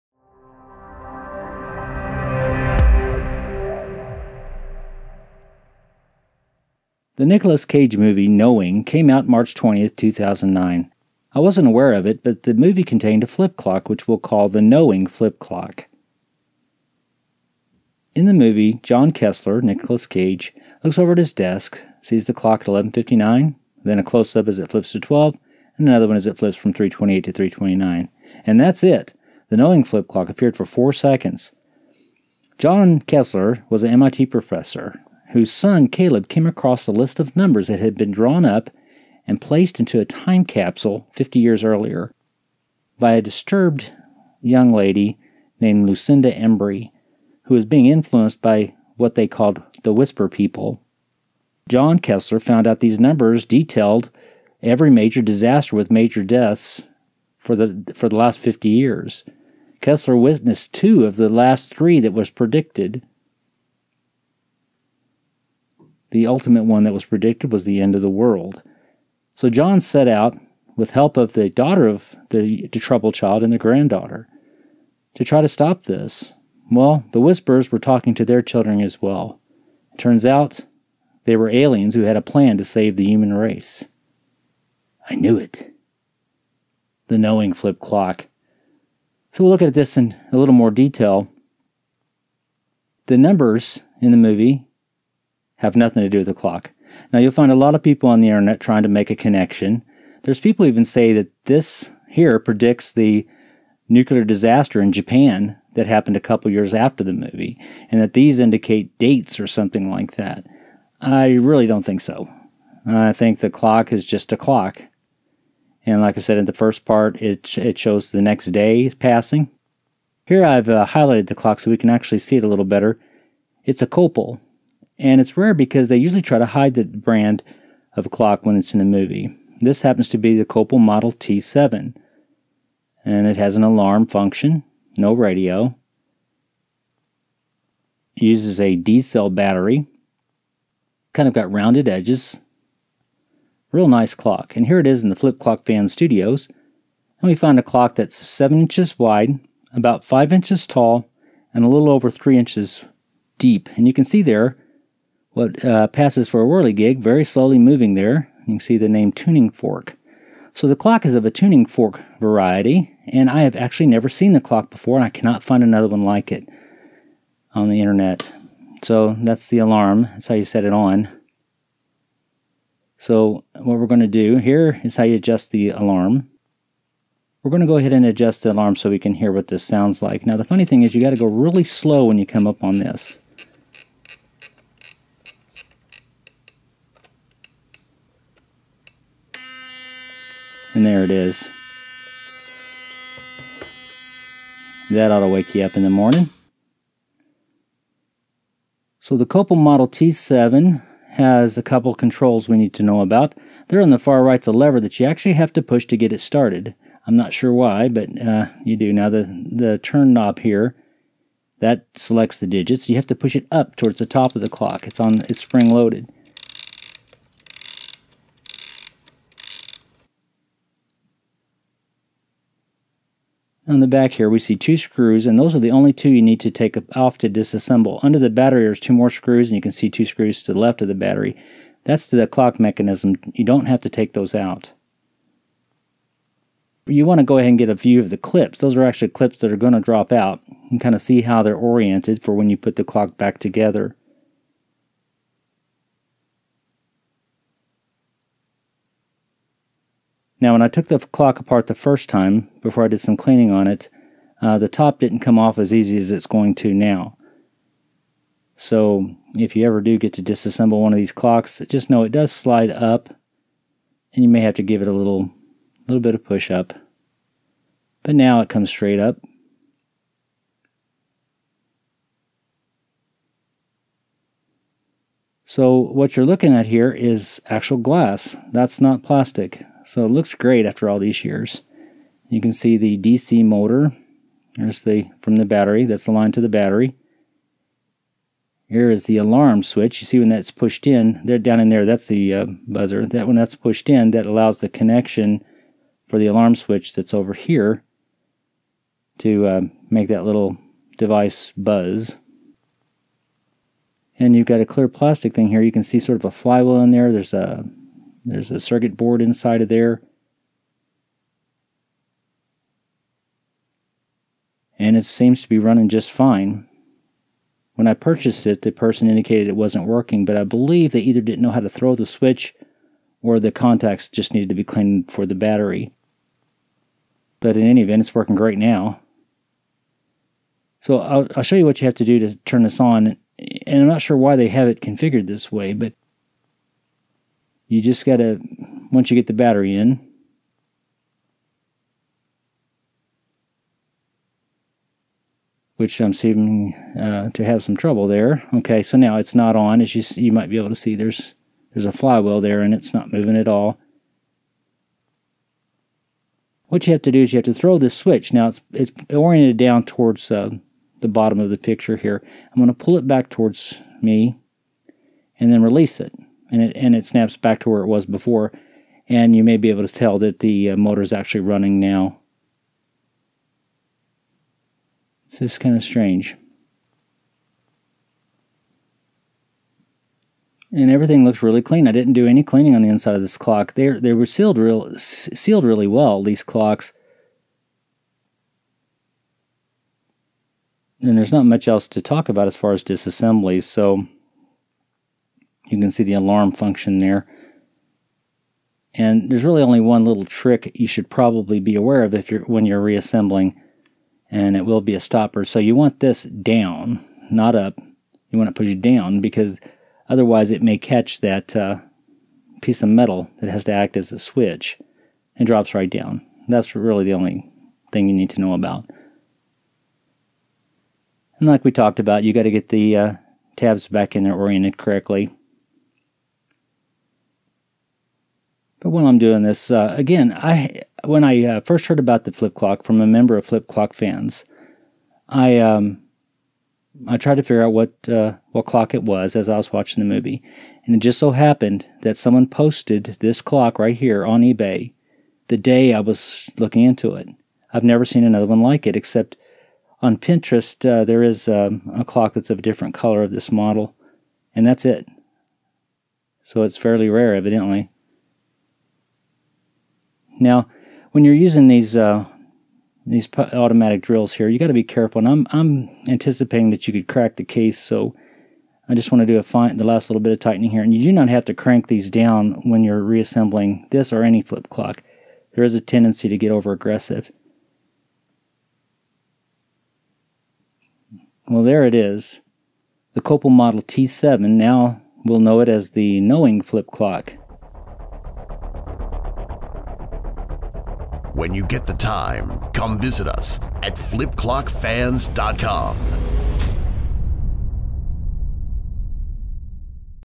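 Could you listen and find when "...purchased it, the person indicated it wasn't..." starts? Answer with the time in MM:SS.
05:17.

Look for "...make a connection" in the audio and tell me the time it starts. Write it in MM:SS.
01:38.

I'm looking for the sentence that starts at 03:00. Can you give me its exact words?
Now the funny thing is you got to go really slow when you come up on this.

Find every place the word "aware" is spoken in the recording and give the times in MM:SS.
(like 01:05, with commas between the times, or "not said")
00:11, 06:41.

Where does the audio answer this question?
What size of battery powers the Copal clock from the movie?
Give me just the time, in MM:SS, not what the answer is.
02:18.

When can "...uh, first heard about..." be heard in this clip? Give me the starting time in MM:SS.
07:11.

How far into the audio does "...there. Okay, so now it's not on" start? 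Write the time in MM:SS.
05:48.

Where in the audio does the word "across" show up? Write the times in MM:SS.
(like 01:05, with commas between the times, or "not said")
00:36.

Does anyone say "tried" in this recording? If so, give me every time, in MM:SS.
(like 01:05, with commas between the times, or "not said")
07:17.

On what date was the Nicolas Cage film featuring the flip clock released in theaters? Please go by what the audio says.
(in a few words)
March 20th, 2009.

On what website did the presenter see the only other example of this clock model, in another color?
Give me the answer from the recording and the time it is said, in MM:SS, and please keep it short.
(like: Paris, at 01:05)
Pinterest, at 07:30.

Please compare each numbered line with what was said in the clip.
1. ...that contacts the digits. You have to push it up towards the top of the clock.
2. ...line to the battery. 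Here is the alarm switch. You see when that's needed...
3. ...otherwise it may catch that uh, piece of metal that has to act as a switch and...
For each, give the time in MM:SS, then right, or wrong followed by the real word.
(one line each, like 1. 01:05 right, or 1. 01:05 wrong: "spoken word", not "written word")
1. 03:31 wrong: "selects", not "contacts"
2. 04:46 wrong: "pushed", not "needed"
3. 06:50 right.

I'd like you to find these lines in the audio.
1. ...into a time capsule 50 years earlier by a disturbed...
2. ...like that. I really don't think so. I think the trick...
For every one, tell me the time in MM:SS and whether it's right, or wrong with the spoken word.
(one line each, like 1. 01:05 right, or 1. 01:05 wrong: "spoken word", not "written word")
1. 00:39 right
2. 01:49 wrong: "clock", not "trick".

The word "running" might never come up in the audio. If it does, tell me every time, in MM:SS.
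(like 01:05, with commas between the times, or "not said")
05:15, 06:11.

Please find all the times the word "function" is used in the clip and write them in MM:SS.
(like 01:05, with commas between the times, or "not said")
02:14, 06:36.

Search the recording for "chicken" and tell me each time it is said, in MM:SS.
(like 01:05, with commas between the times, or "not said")
not said.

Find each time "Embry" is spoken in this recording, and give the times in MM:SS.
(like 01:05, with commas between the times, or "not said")
00:46.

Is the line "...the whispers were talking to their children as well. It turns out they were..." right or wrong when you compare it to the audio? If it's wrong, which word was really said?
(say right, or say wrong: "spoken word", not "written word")
right.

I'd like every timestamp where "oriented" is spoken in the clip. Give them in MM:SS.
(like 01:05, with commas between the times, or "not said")
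04:01, 05:59, 07:04.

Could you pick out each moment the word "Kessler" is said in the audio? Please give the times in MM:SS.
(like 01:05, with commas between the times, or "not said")
00:19, 00:32, 00:51, 00:59.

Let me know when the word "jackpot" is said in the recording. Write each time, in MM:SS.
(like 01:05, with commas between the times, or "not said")
not said.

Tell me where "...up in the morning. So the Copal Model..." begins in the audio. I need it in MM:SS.
03:15.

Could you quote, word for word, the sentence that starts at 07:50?
And you do not have to crank these down when you're reassembling this or any flip clock.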